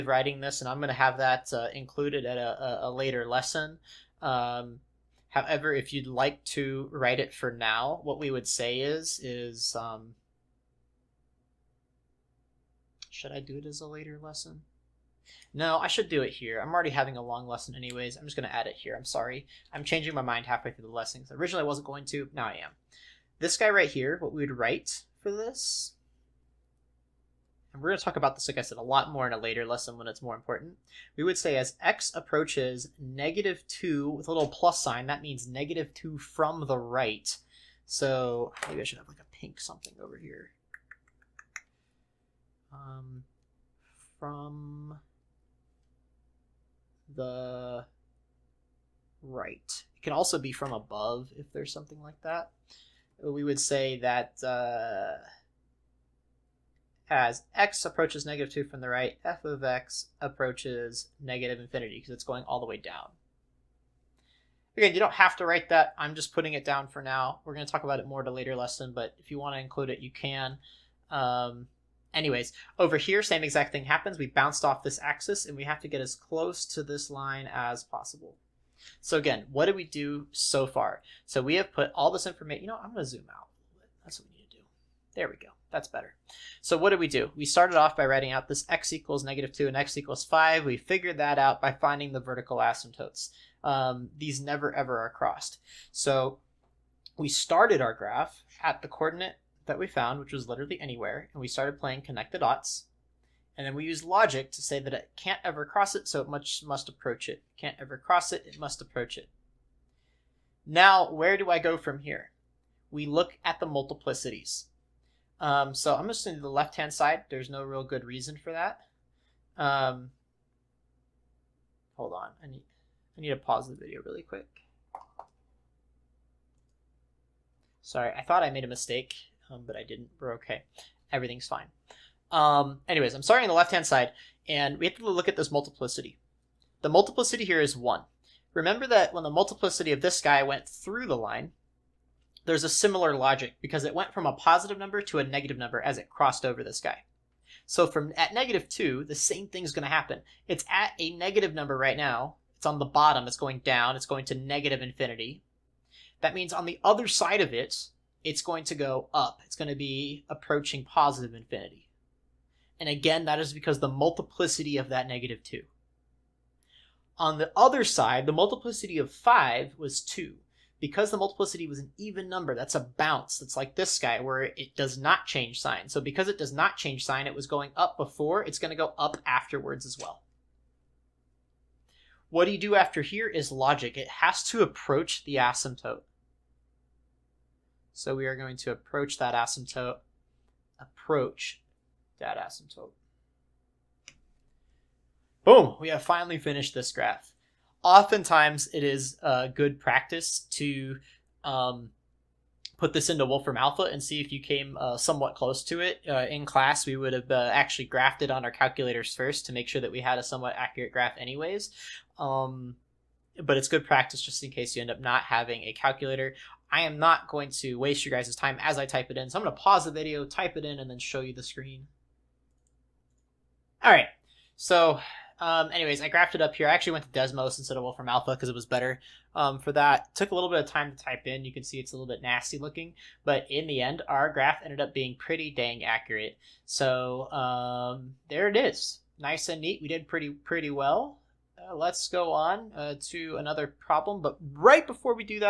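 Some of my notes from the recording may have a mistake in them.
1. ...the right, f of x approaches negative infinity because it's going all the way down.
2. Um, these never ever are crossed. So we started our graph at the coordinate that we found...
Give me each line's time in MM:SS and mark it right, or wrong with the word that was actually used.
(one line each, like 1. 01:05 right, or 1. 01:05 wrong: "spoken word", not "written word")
1. 00:58 right
2. 01:33 right.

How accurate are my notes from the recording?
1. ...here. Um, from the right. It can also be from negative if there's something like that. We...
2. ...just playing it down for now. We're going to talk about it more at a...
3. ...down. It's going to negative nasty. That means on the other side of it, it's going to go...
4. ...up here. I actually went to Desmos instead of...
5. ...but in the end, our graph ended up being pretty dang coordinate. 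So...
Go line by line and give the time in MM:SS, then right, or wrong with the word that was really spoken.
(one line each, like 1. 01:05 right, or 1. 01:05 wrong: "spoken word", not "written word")
1. 00:40 wrong: "above", not "negative"
2. 01:06 wrong: "putting", not "playing"
3. 02:33 wrong: "infinity", not "nasty"
4. 03:46 right
5. 03:53 wrong: "accurate", not "coordinate".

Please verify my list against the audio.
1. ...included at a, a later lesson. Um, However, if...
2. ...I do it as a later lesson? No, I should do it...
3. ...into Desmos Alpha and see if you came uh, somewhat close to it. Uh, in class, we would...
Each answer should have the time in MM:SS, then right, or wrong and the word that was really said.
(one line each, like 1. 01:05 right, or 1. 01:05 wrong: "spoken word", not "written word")
1. 00:01 right
2. 00:13 right
3. 03:23 wrong: "Wolfram", not "Desmos".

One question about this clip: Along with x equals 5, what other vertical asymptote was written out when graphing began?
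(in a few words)
x = -2.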